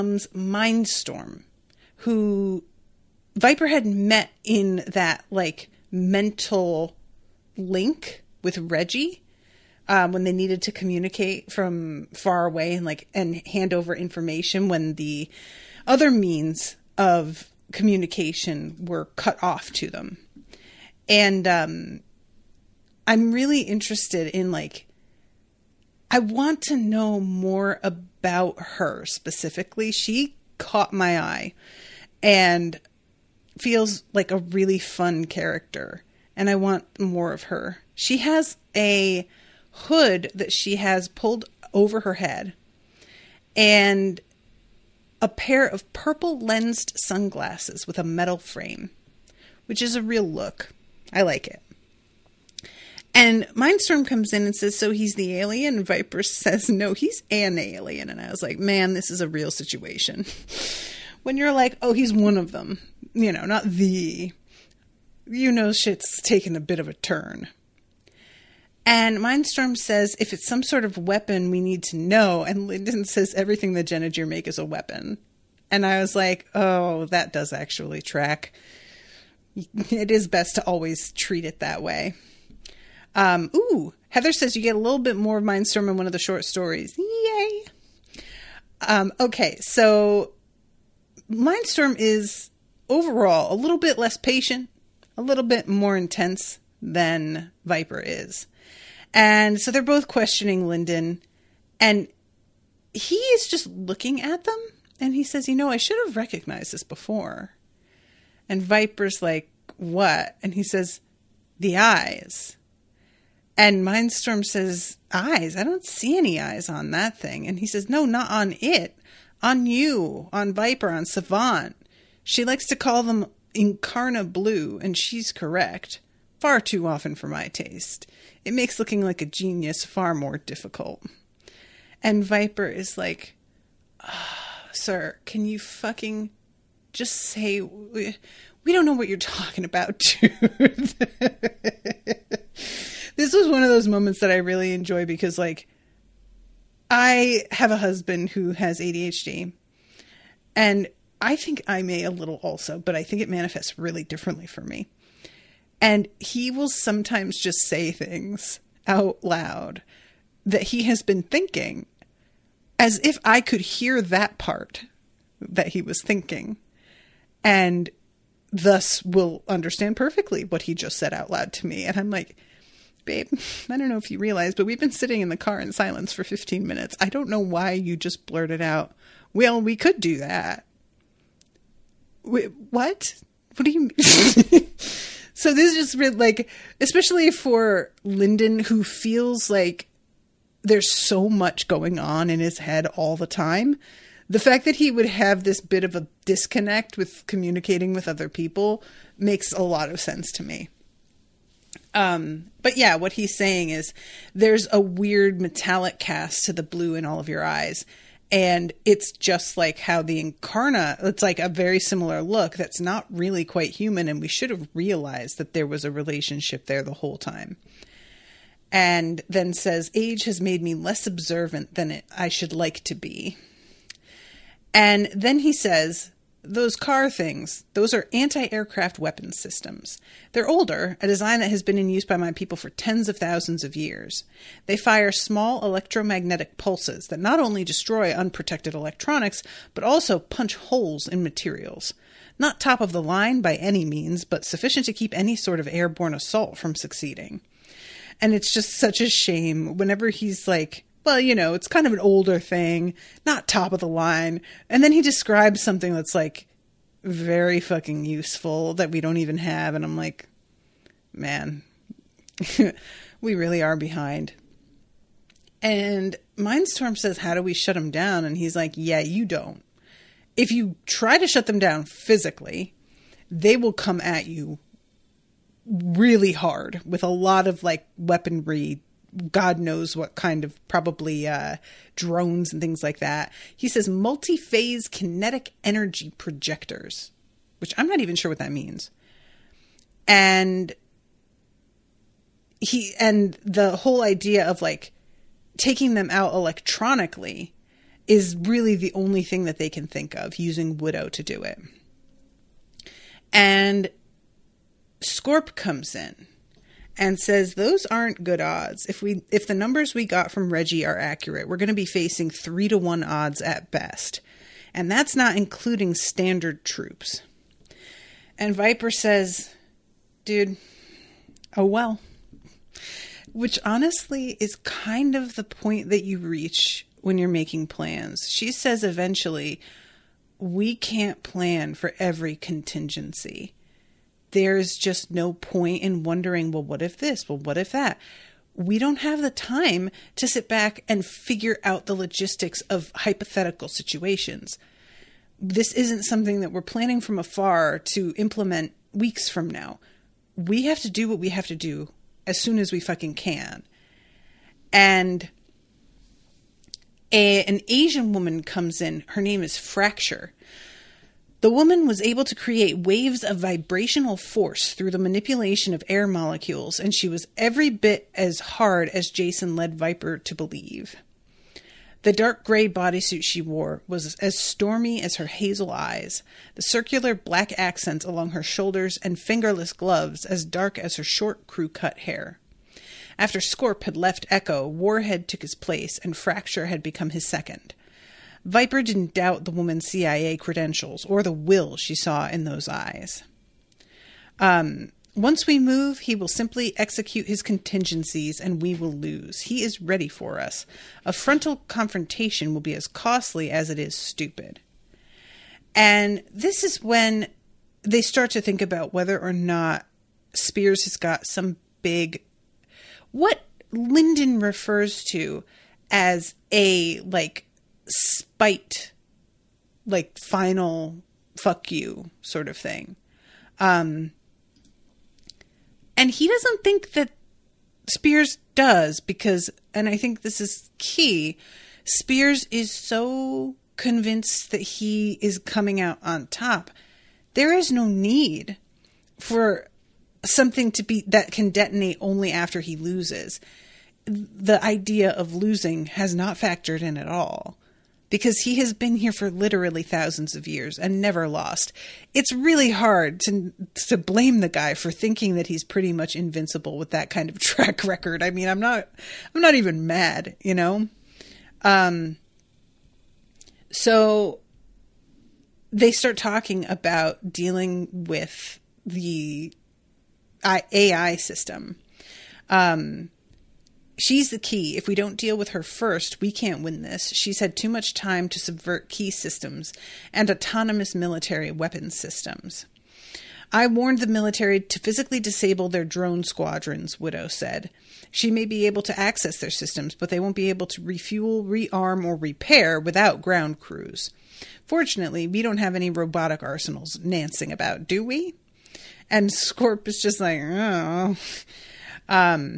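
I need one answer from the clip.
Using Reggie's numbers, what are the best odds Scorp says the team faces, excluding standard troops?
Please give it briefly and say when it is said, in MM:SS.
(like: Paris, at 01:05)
3 to 1, at 05:12.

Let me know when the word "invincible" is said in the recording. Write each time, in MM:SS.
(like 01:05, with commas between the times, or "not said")
07:36.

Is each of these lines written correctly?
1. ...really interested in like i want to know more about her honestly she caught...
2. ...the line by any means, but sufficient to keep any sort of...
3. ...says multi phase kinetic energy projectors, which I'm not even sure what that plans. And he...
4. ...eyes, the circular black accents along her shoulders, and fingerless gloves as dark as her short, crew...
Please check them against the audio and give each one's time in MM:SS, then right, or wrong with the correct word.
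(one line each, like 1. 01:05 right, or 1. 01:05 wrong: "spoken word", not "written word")
1. 00:23 wrong: "specifically", not "honestly"
2. 04:02 right
3. 04:43 wrong: "means", not "plans"
4. 06:15 right.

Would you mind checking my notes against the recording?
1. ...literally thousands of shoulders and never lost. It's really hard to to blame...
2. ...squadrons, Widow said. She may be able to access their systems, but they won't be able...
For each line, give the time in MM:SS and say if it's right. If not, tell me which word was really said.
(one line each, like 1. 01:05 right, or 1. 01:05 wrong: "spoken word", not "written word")
1. 07:29 wrong: "years", not "shoulders"
2. 08:06 right.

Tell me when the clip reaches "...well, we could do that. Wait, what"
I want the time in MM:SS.
02:59.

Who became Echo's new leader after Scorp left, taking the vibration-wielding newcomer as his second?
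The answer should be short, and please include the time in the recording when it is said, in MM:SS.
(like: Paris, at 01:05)
Warhead, at 06:24.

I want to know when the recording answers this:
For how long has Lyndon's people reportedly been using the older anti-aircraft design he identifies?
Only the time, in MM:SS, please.
03:52.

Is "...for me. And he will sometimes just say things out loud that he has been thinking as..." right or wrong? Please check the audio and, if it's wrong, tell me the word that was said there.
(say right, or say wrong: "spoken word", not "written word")
right.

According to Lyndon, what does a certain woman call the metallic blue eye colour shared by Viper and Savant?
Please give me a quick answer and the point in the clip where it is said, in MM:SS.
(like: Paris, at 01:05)
Incarna Blue, at 02:03.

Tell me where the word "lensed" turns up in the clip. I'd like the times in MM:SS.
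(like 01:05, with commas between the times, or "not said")
00:46.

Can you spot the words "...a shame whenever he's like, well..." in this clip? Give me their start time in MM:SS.
04:09.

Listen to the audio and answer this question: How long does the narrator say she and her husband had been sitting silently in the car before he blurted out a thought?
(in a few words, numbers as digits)
15 minutes.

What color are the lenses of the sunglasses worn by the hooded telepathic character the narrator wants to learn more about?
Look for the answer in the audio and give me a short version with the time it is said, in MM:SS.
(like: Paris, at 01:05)
Purple, at 00:45.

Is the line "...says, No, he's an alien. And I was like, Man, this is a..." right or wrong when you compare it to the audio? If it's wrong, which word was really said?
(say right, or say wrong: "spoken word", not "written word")
right.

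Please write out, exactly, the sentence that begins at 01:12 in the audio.
And Linden says, everything that Genegier make is a weapon.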